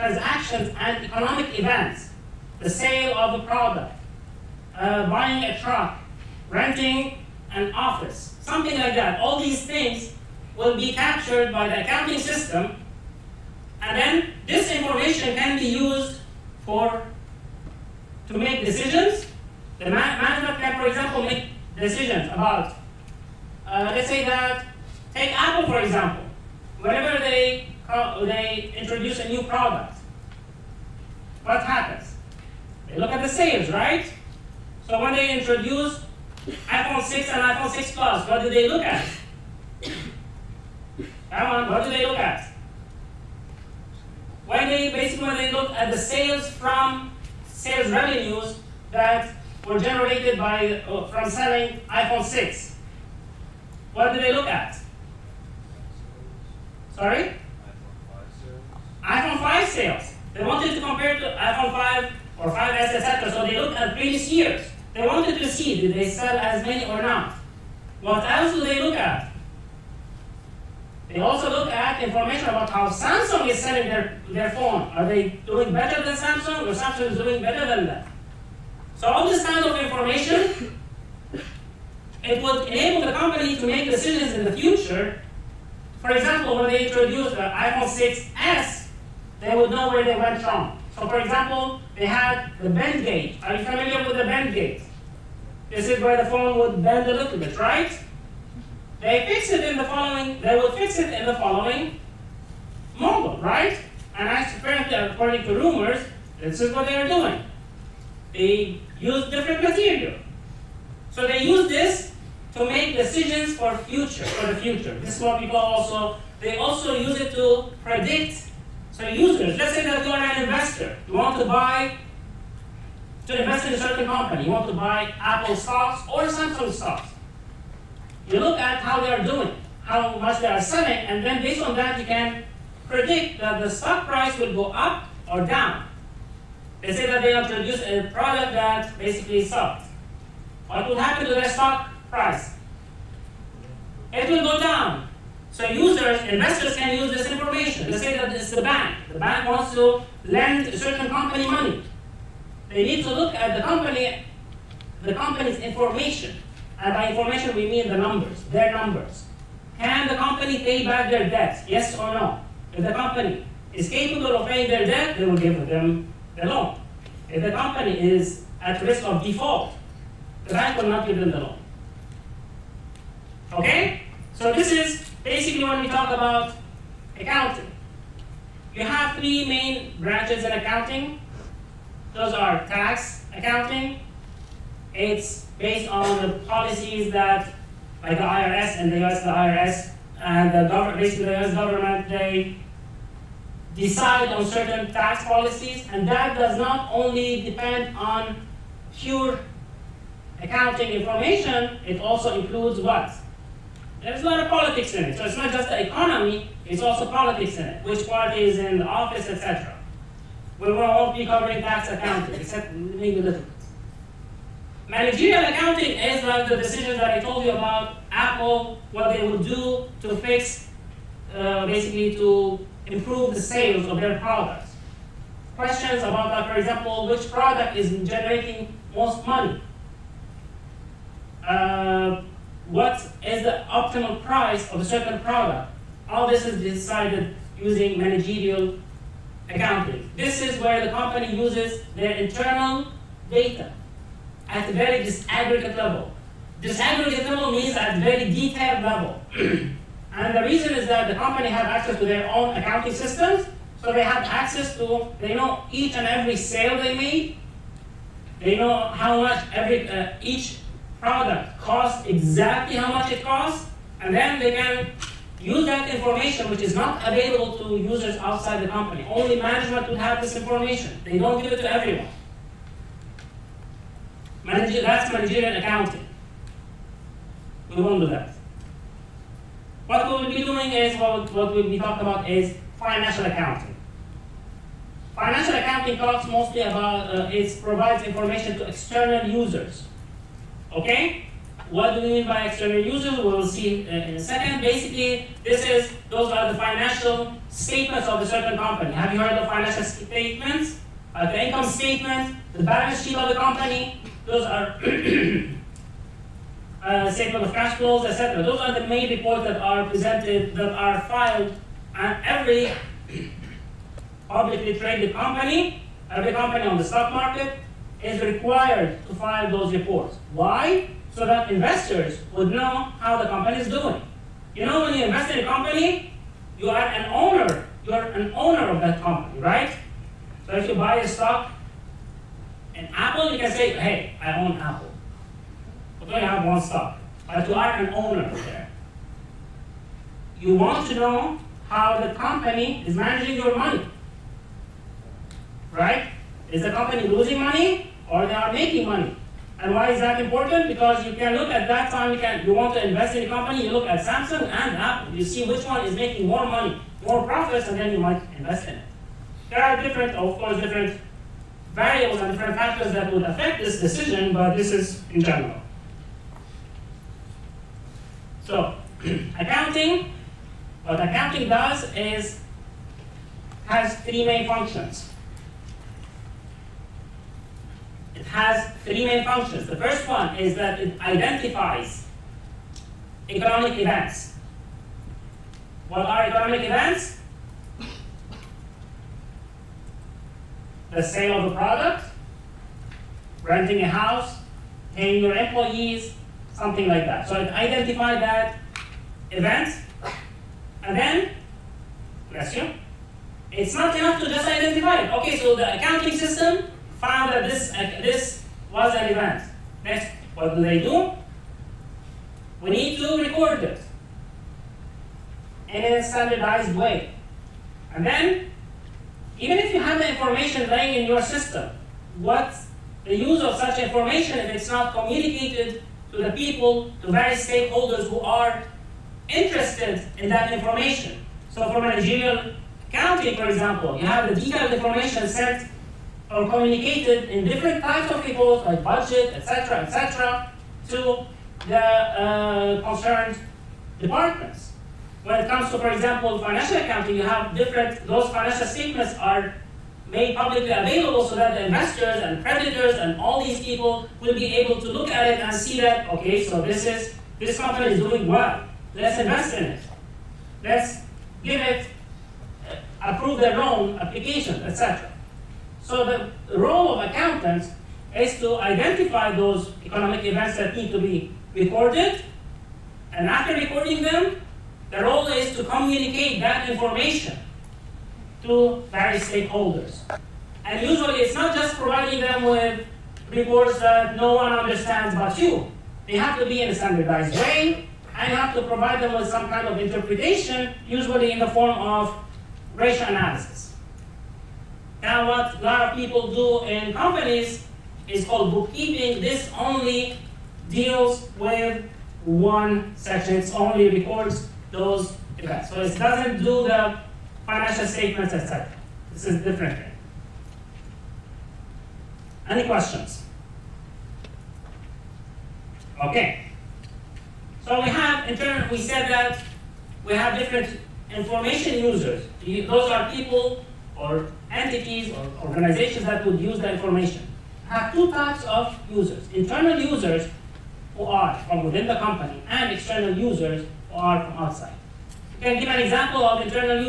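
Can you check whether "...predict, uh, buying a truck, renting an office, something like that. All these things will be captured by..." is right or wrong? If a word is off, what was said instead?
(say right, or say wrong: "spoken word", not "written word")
wrong: "product", not "predict".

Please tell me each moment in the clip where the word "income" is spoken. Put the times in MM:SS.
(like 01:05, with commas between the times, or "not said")
05:01.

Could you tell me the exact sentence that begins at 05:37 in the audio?
But you are an owner there.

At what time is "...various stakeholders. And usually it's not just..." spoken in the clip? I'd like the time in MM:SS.
07:58.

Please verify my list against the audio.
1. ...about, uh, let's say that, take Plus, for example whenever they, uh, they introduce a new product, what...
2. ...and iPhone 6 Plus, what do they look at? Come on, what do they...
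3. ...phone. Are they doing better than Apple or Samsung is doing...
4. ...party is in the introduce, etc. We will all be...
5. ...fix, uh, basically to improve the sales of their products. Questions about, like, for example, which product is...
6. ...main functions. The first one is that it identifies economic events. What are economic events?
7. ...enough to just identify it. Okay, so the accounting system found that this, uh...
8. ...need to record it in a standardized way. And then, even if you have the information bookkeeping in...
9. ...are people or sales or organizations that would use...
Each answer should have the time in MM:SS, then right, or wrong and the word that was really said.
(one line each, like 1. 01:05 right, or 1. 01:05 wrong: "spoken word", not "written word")
1. 00:22 wrong: "Apple", not "Plus"
2. 00:37 right
3. 01:14 wrong: "Samsung", not "Apple"
4. 03:28 wrong: "office", not "introduce"
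5. 03:40 right
6. 06:19 right
7. 06:43 right
8. 06:52 wrong: "laying", not "bookkeeping"
9. 08:42 wrong: "entities", not "sales".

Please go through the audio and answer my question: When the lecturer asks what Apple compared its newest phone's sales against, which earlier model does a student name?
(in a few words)
iPhone 5.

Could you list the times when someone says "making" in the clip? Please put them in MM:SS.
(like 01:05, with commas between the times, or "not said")
05:48, 05:55.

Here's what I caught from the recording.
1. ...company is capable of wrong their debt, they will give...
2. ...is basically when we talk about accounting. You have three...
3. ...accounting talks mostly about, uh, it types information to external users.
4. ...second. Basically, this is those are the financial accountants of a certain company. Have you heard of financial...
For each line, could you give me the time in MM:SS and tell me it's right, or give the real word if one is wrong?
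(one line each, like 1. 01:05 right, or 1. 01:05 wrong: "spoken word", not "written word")
1. 02:42 wrong: "paying", not "wrong"
2. 02:54 right
3. 04:45 wrong: "provides", not "types"
4. 04:54 wrong: "statements", not "accountants".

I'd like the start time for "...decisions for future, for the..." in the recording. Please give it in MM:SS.
01:52.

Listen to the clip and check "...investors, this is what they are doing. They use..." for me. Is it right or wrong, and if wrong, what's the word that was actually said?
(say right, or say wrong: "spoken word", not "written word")
wrong: "rumors", not "investors".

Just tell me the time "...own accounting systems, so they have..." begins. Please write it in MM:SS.
04:12.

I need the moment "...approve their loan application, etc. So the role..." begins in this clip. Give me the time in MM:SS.
07:43.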